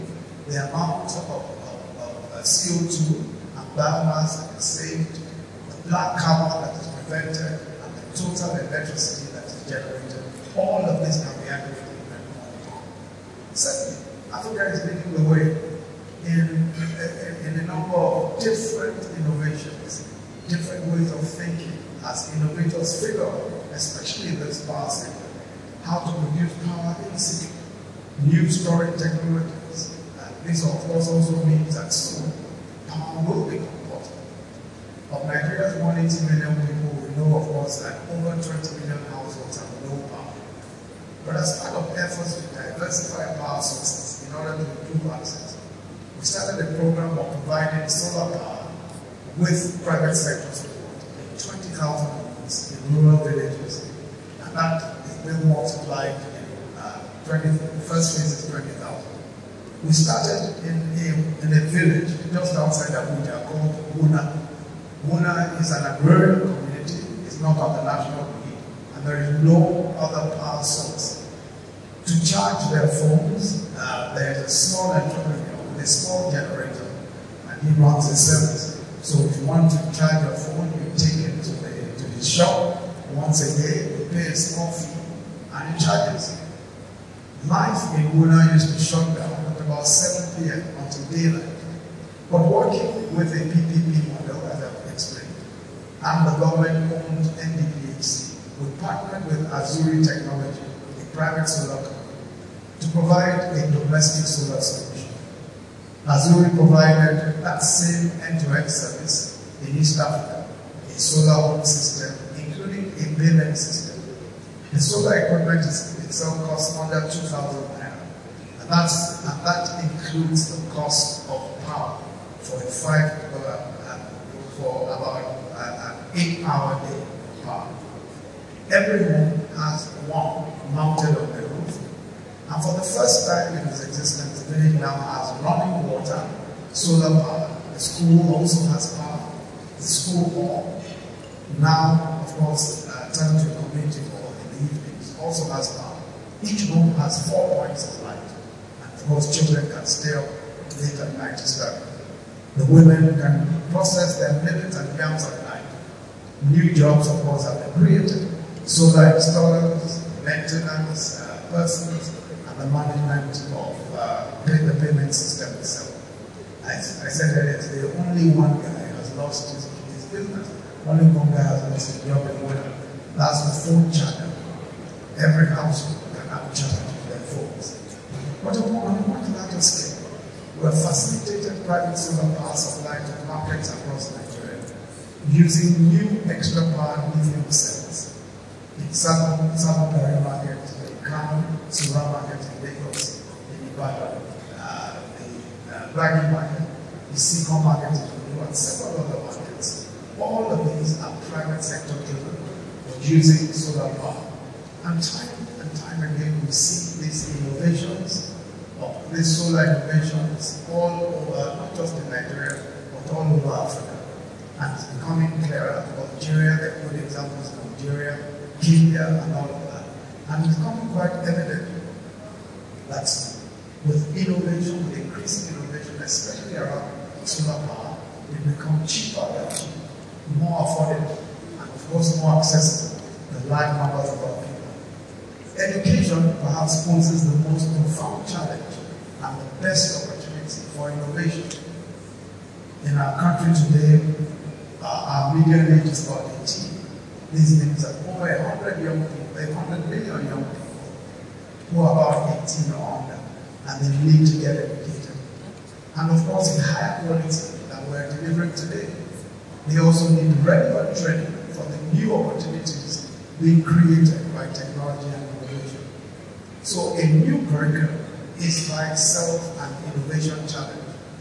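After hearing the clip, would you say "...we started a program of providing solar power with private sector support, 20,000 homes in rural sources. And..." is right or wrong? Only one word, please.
wrong.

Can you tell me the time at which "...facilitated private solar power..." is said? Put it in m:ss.
3:00.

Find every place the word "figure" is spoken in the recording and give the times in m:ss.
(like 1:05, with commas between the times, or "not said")
0:23.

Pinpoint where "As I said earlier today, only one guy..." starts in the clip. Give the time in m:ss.
2:46.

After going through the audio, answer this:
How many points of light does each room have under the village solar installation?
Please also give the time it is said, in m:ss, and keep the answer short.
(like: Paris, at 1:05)
4, at 2:27.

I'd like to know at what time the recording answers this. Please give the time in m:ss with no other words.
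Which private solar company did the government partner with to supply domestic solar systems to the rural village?
1:39.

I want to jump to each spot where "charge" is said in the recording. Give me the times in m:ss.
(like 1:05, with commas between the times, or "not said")
1:12, 1:19, 1:25.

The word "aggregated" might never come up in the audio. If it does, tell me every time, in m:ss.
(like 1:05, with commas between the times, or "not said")
0:11.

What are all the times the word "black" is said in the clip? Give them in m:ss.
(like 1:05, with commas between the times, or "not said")
0:05, 3:15.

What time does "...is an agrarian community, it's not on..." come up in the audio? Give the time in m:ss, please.
1:05.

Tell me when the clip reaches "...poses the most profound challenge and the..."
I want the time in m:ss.
3:56.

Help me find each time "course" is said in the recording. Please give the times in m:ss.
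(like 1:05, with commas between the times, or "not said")
0:30, 0:37, 2:22, 2:29, 2:37, 3:51, 4:16.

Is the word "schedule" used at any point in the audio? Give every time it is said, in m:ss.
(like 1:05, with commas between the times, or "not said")
not said.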